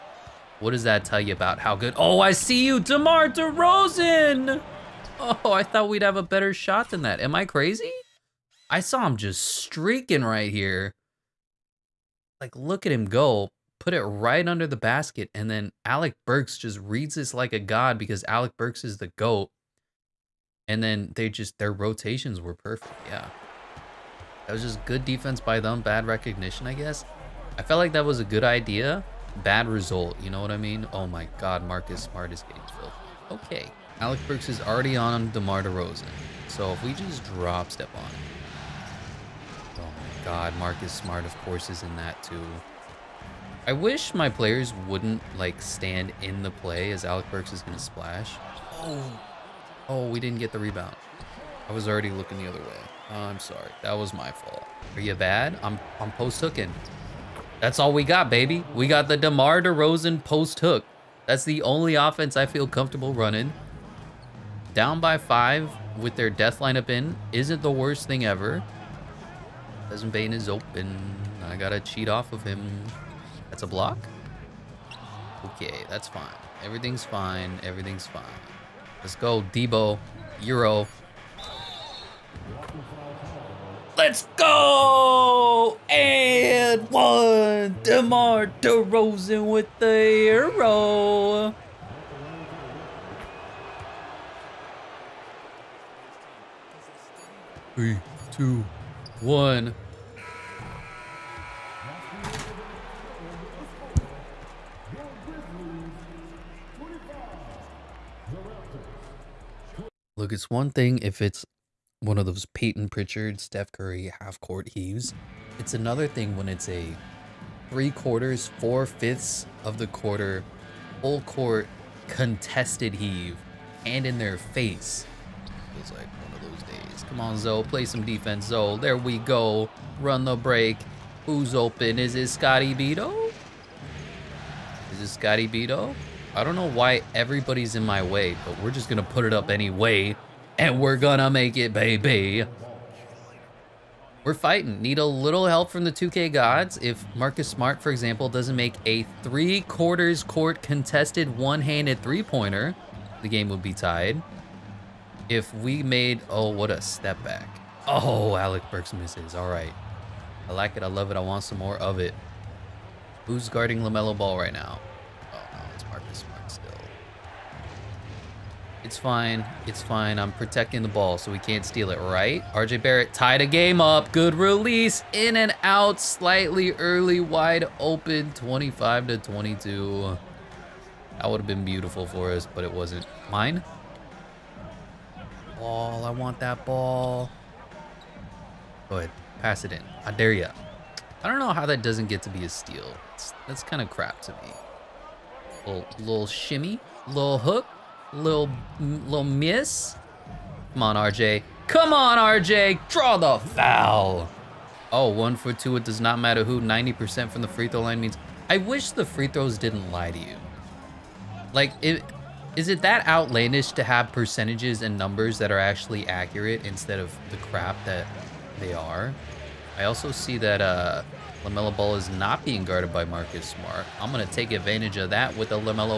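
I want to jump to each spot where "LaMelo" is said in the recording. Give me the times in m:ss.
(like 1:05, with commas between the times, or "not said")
2:43, 3:41.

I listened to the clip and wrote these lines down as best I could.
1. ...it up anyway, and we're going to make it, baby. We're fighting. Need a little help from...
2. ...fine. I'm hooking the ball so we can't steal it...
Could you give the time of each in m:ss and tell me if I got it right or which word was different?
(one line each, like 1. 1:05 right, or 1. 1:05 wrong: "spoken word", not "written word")
1. 2:19 right
2. 2:49 wrong: "protecting", not "hooking".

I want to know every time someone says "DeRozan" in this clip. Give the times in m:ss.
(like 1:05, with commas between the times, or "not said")
0:03, 0:35, 0:59, 1:28.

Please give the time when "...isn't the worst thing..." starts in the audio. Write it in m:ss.
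1:07.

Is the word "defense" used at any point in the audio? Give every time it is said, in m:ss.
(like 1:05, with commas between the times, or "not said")
0:25, 2:08.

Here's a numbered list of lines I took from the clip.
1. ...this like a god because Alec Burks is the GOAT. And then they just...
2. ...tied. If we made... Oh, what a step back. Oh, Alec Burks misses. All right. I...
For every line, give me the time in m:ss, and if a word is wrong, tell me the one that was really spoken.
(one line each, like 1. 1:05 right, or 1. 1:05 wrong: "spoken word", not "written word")
1. 0:17 right
2. 2:33 right.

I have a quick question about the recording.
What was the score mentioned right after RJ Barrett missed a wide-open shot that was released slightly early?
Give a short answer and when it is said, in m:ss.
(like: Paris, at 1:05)
25 to 22, at 2:58.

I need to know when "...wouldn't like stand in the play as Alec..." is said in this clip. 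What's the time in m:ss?
0:44.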